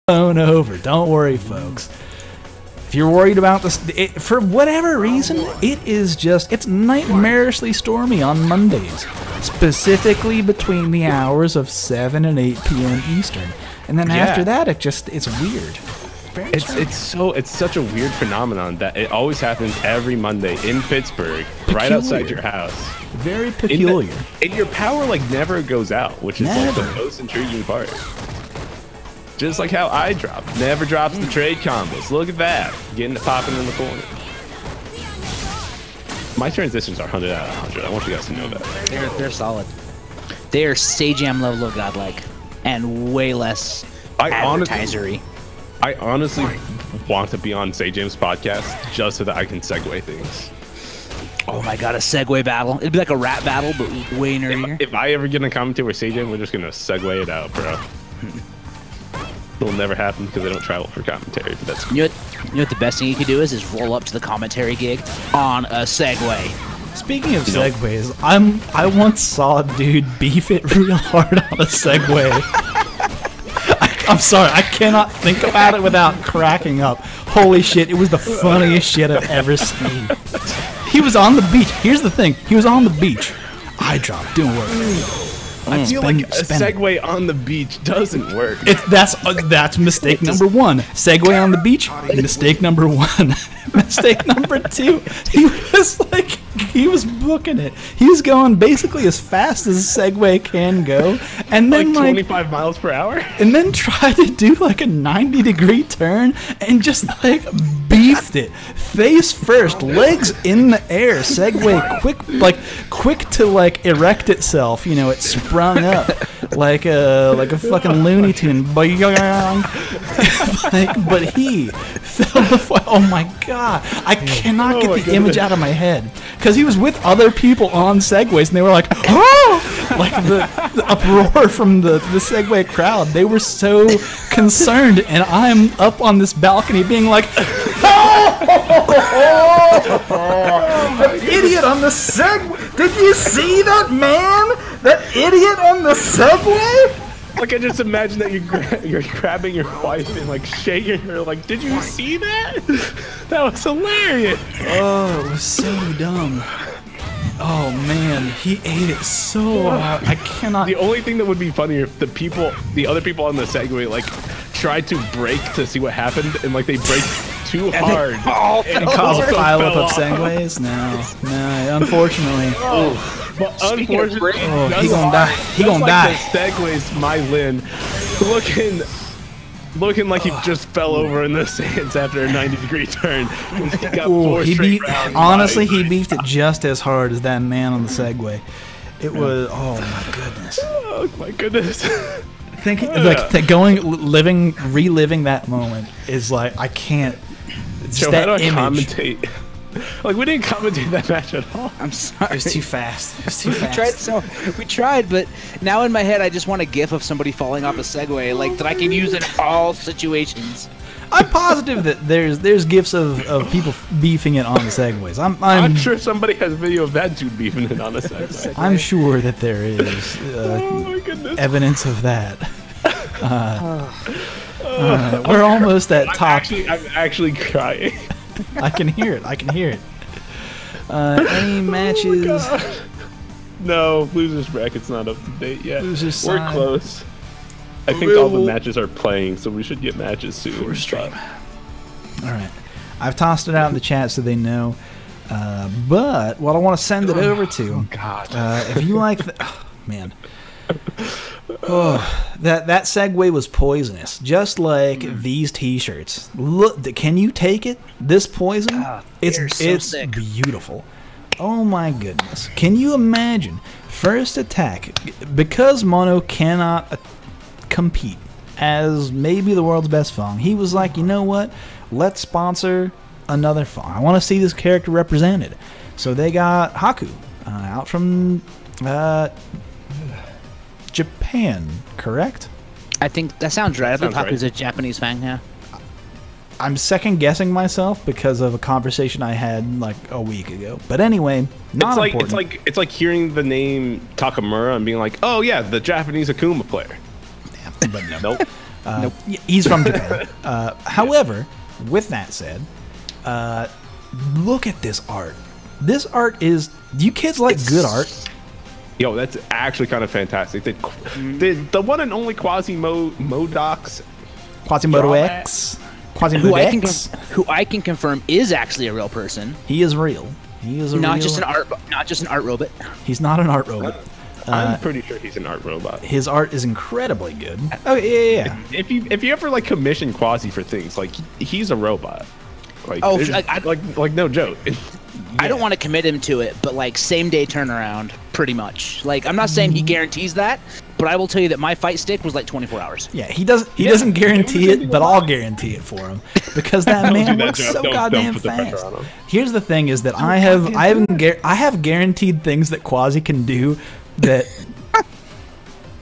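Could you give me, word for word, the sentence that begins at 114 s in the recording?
You know, it sprung up like a like a fucking Looney Tune.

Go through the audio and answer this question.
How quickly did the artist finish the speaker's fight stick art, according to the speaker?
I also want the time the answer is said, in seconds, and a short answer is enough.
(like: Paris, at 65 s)
24 hours, at 342 s.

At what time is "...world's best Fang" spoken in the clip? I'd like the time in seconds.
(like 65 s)
269 s.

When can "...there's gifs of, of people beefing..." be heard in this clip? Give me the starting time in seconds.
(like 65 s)
212 s.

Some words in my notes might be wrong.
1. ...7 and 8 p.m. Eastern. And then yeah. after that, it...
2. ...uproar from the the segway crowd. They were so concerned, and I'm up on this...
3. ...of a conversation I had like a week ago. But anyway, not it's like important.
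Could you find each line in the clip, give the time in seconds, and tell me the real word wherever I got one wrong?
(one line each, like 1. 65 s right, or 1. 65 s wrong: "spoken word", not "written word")
1. 11 s right
2. 130 s right
3. 288 s right.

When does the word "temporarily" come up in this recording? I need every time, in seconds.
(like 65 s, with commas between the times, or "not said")
not said.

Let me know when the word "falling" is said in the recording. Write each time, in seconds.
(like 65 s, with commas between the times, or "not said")
207 s.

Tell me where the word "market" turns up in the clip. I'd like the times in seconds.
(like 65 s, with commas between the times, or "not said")
not said.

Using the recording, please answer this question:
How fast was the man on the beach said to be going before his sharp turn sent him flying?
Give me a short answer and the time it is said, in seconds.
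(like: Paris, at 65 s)
25 miles per hour, at 102 s.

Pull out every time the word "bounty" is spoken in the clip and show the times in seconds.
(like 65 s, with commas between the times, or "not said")
not said.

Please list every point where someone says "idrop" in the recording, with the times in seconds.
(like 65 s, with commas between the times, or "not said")
29 s, 83 s.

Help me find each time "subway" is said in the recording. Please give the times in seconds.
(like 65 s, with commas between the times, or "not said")
141 s, 145 s.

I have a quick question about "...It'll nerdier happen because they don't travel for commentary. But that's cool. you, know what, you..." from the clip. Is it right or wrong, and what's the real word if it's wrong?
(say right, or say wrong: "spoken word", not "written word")
wrong: "never", not "nerdier".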